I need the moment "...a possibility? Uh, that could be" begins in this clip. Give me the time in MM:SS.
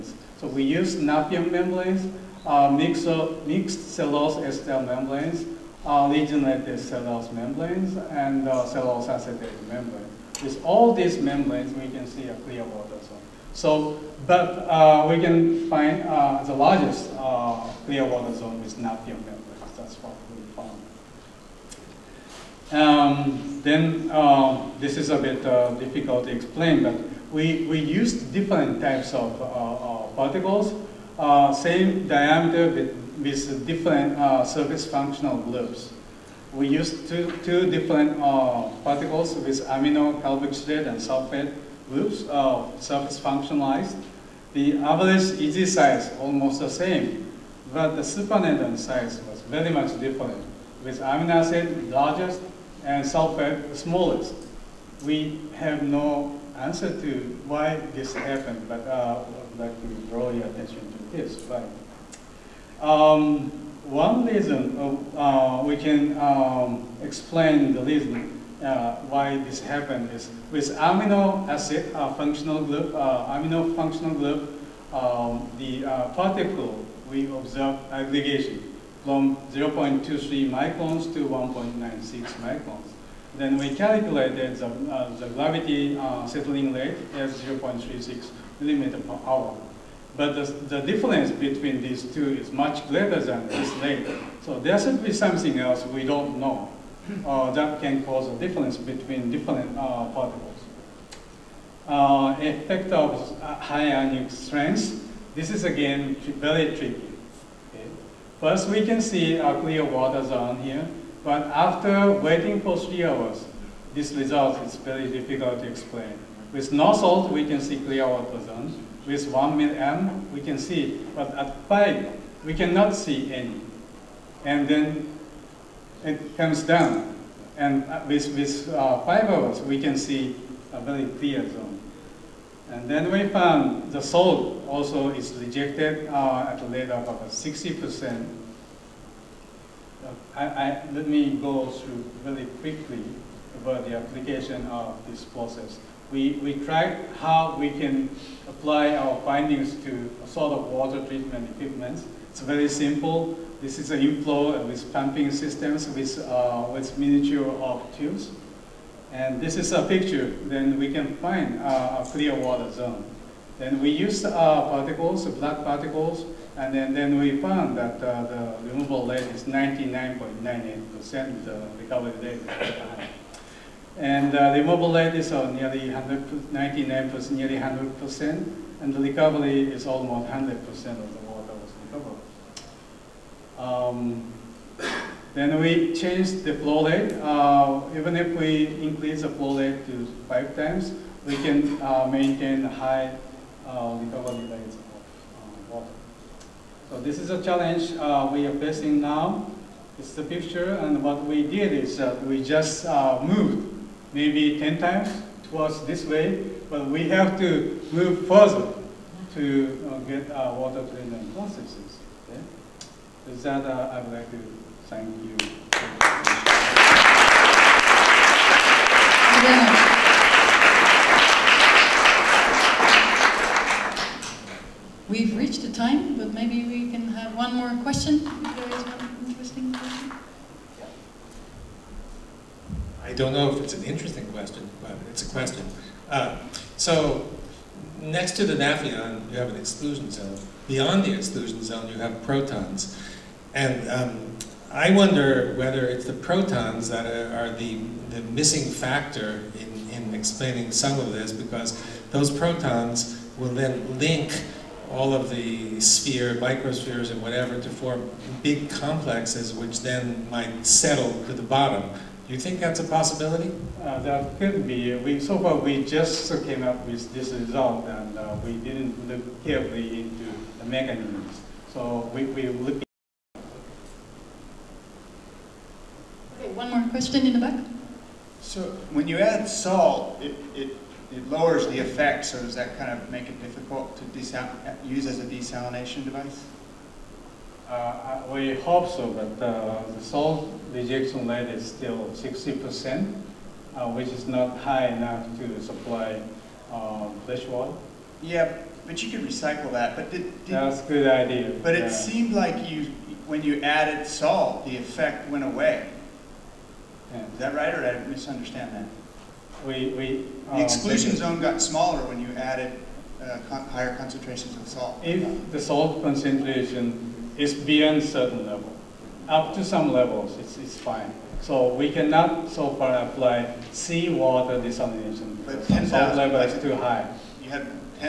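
04:22.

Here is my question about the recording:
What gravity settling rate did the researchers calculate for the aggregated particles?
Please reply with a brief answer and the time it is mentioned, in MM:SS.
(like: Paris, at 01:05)
0.36 millimeter per hour, at 01:27.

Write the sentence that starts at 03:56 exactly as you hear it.
Uh, so next to the Nafion, you have an exclusion zone.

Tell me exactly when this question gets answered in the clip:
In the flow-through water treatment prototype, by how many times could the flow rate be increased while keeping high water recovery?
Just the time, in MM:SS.
03:10.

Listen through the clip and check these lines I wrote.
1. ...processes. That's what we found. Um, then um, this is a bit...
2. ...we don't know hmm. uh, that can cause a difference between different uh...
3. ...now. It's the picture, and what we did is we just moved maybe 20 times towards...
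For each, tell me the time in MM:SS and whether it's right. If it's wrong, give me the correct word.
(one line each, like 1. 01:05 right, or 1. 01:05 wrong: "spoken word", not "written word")
1. 00:19 wrong: "membranes", not "processes"
2. 01:35 right
3. 03:19 wrong: "10", not "20".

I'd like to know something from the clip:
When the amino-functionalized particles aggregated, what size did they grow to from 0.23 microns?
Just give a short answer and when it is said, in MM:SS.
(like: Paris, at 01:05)
1.96 microns, at 01:21.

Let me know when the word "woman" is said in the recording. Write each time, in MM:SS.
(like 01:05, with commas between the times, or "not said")
not said.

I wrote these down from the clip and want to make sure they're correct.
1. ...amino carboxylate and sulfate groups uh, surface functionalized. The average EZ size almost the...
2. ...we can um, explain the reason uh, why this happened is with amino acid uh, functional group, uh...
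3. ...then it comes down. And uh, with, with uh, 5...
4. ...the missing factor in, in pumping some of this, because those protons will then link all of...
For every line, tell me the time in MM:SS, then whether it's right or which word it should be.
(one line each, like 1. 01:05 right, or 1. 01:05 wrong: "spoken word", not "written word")
1. 00:39 right
2. 01:05 right
3. 02:04 right
4. 04:08 wrong: "explaining", not "pumping".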